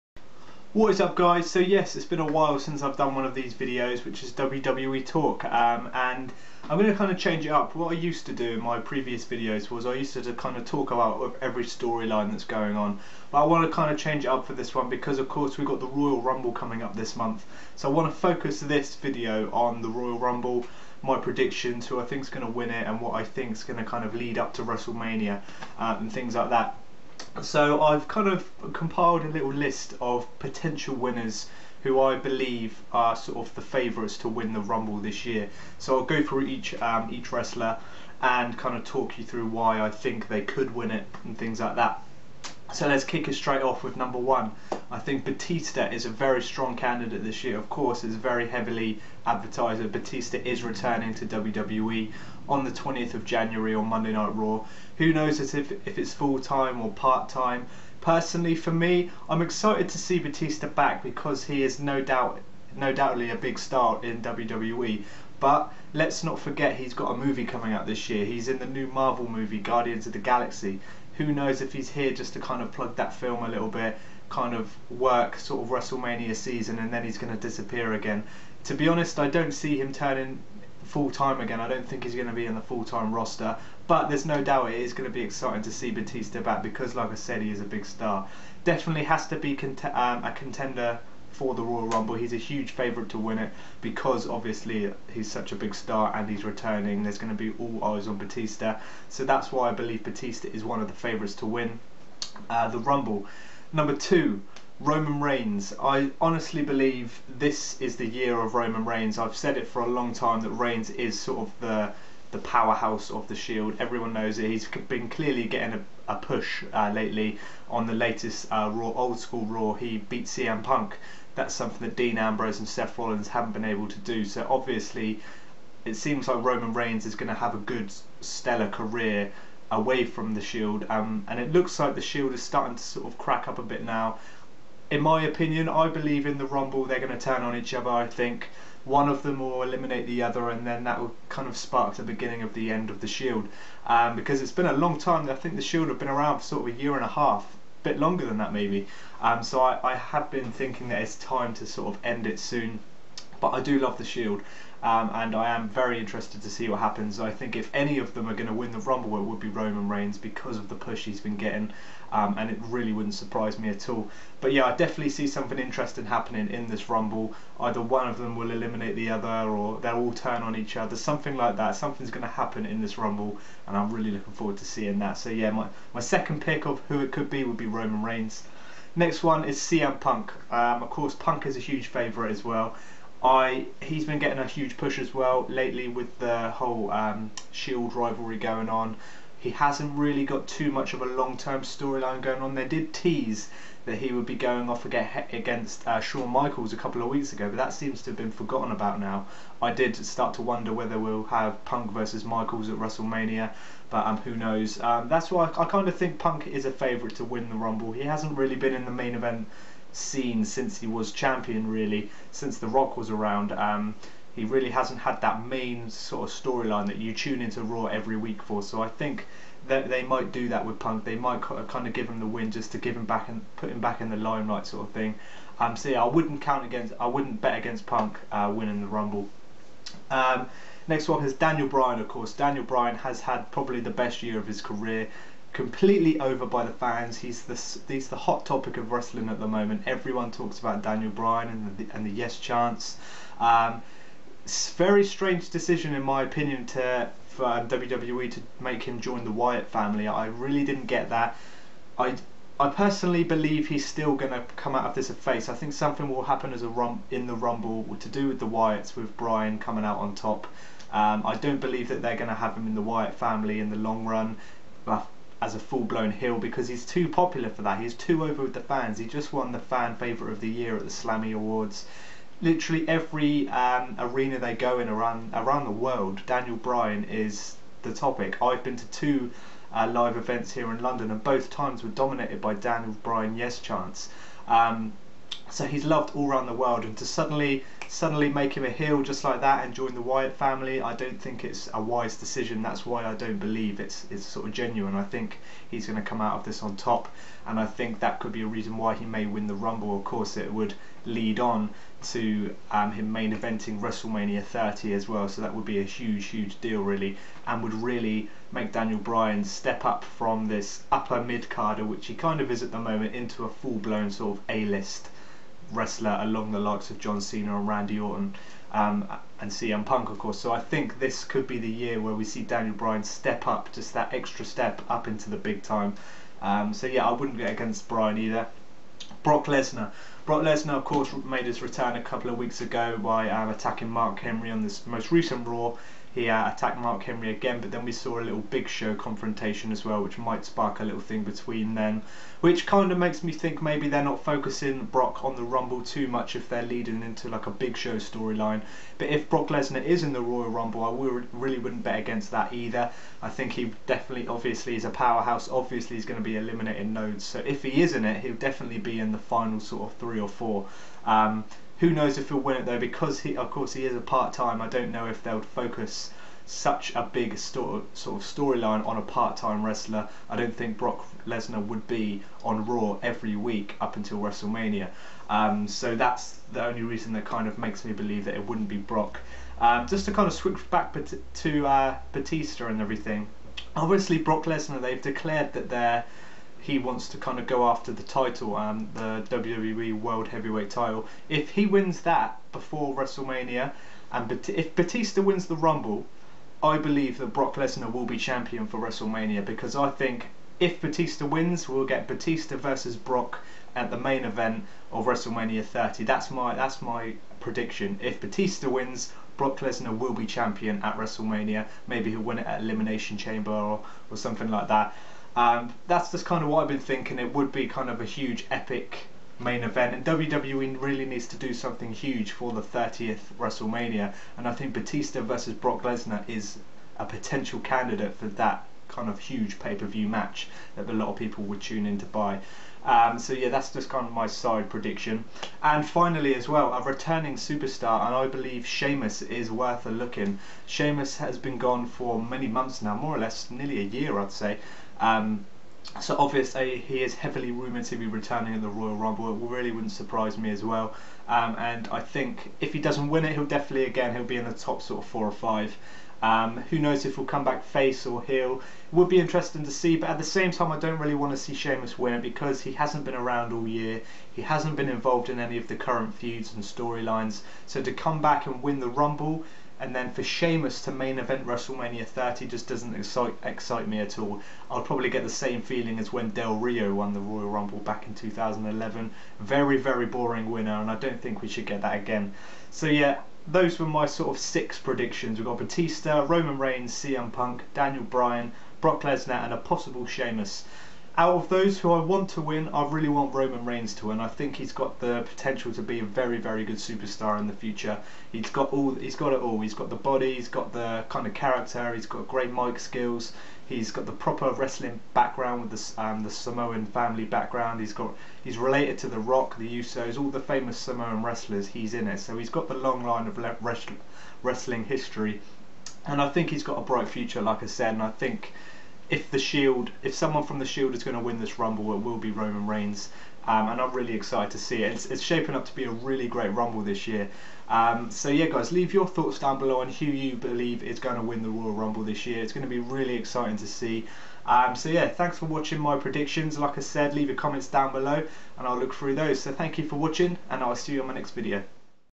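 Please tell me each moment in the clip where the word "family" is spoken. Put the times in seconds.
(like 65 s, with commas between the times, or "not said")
249 s, 263 s, 290 s, 506 s.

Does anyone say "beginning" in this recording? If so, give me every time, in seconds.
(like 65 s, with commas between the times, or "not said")
142 s.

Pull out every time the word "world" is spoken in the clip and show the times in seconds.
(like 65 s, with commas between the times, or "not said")
275 s, 286 s, 389 s.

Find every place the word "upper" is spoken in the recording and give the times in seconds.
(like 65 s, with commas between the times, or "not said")
310 s.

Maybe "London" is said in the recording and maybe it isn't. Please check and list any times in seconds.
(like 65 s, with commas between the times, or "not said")
280 s.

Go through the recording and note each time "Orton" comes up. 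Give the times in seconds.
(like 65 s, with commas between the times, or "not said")
317 s.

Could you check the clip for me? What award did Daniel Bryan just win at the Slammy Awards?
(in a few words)
Fan favourite of the year.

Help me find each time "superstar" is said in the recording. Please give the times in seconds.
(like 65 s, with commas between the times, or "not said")
437 s, 496 s.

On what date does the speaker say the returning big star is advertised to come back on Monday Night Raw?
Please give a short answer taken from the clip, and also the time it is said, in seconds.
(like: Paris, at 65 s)
20th of January, at 52 s.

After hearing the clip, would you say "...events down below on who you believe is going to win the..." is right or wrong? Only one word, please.
wrong.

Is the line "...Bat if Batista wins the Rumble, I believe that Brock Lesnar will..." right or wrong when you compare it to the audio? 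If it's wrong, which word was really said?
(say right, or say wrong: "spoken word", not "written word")
right.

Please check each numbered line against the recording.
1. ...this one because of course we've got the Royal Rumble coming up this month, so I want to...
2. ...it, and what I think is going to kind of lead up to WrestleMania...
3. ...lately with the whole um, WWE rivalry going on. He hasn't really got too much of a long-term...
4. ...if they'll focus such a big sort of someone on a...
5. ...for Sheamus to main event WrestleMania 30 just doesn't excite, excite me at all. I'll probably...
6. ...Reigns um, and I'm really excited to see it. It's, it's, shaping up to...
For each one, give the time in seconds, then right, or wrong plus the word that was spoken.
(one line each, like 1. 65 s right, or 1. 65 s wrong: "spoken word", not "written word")
1. 14 s right
2. 22 s right
3. 185 s wrong: "Shield", not "WWE"
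4. 365 s wrong: "storyline", not "someone"
5. 470 s right
6. 522 s right.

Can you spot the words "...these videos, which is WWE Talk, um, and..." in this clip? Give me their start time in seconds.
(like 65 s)
3 s.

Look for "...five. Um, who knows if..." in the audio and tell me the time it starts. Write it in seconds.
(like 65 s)
455 s.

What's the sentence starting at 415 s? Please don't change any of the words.
Um, that's just kind of what I've been thinking.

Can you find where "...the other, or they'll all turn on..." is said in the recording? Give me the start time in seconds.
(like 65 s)
168 s.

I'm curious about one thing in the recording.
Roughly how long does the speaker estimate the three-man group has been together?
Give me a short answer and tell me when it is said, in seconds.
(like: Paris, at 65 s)
A year and a half, at 146 s.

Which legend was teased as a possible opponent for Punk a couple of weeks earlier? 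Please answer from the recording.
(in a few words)
Shawn Michaels.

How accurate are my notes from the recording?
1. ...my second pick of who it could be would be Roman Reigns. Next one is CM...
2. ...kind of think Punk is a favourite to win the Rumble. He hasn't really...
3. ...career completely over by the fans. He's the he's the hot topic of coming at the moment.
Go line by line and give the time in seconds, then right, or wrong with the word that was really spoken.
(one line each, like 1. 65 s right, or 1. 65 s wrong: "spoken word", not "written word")
1. 175 s right
2. 205 s right
3. 234 s wrong: "wrestling", not "coming".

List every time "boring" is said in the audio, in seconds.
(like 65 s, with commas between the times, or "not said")
480 s.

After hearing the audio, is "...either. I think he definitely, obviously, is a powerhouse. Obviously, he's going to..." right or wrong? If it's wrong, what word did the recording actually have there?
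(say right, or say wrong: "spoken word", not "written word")
right.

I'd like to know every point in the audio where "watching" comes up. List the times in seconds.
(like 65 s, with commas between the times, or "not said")
535 s, 539 s.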